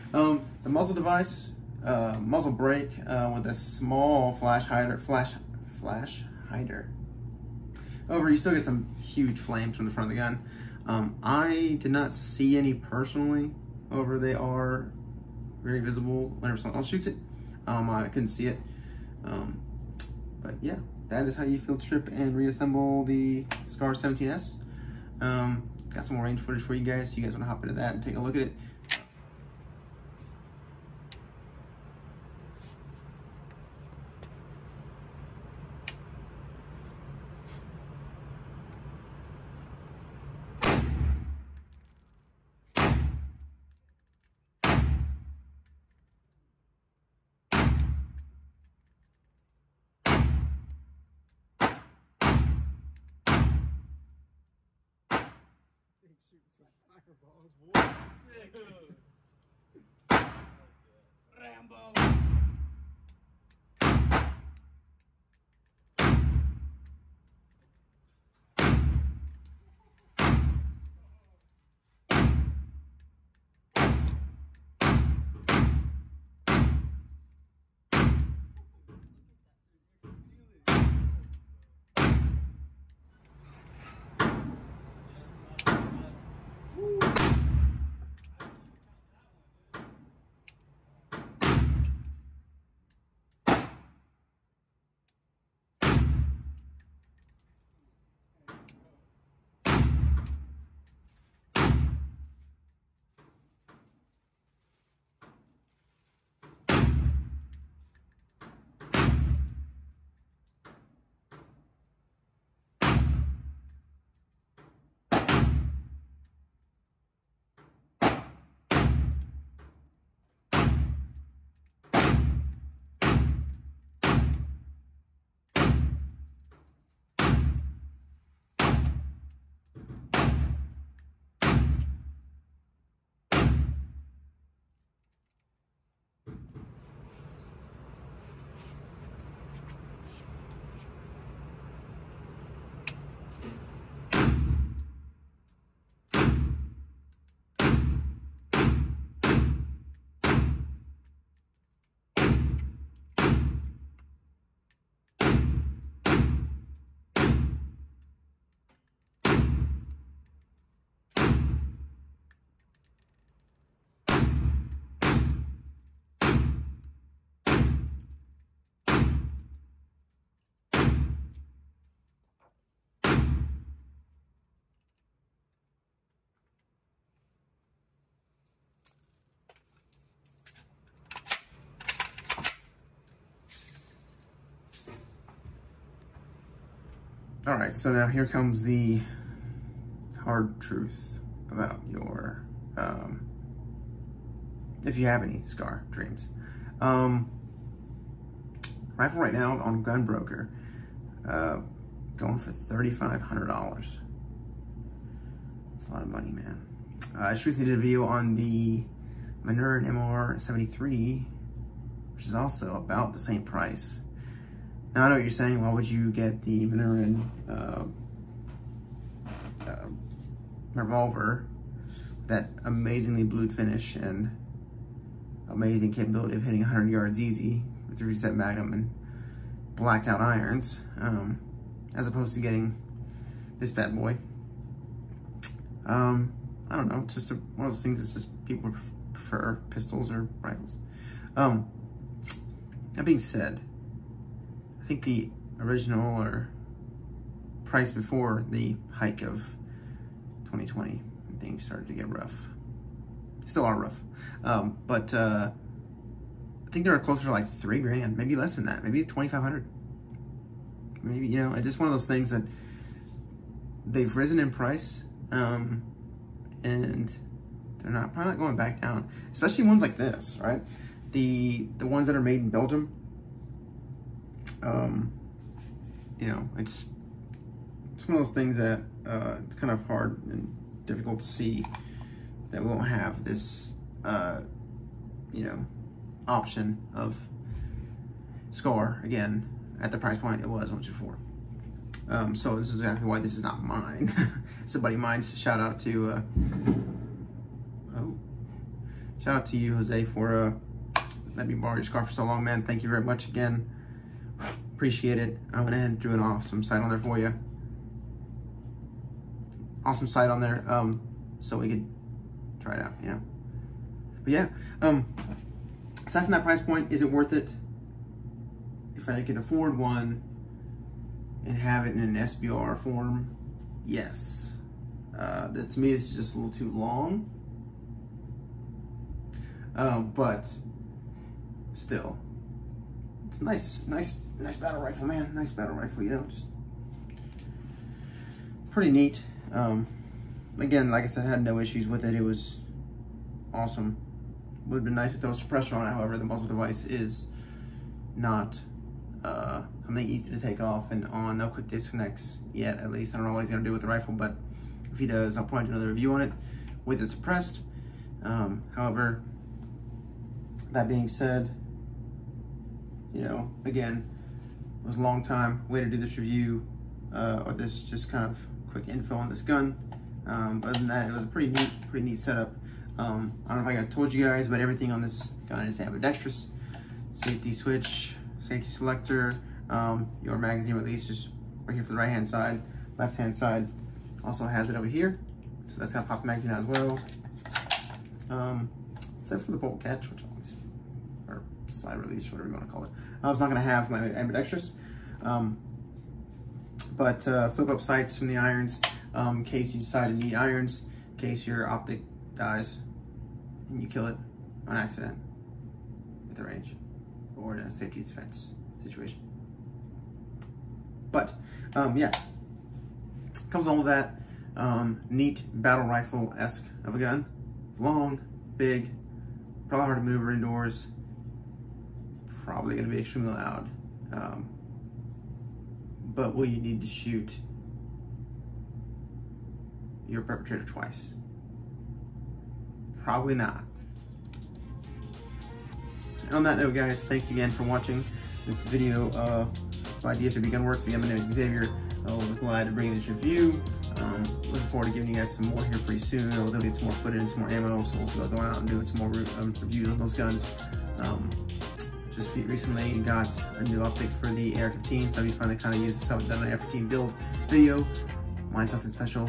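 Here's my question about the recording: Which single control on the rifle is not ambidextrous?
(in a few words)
bolt catch.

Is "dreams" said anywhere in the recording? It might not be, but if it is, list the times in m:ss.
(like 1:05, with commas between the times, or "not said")
3:15.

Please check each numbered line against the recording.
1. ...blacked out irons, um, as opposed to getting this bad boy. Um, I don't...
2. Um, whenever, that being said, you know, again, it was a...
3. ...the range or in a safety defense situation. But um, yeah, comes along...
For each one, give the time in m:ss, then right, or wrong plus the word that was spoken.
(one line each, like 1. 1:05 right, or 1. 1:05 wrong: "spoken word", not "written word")
1. 3:49 right
2. 5:58 wrong: "however", not "whenever"
3. 6:46 right.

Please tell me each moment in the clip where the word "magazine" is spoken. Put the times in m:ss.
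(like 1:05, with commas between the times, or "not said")
6:20, 6:26.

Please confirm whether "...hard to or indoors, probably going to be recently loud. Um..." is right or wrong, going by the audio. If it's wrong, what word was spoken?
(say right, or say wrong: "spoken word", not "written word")
wrong: "extremely", not "recently".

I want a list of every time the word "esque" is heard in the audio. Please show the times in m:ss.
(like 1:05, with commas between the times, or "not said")
6:55.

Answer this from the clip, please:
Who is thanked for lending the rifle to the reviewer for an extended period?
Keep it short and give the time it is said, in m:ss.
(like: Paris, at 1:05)
Jose, at 4:59.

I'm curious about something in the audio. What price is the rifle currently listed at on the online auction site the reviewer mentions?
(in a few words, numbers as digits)
$3,500.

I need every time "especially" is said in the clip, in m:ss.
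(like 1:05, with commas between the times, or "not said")
4:29.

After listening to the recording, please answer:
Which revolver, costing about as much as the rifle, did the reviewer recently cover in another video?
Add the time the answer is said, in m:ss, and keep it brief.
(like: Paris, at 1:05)
Manurhin MR73, at 3:29.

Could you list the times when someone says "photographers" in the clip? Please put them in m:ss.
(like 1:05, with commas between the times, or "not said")
not said.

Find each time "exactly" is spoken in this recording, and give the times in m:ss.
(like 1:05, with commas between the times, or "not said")
4:52.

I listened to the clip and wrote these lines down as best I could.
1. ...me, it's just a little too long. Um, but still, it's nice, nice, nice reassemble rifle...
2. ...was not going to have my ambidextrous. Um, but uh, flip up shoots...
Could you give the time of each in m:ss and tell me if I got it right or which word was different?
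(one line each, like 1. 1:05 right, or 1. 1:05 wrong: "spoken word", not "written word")
1. 5:25 wrong: "battle", not "reassemble"
2. 6:33 wrong: "sights", not "shoots".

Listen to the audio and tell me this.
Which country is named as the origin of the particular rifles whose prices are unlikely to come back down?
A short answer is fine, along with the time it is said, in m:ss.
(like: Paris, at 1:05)
Belgium, at 4:32.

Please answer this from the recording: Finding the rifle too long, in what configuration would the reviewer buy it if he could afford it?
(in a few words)
SBR.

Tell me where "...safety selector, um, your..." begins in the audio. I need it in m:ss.
6:18.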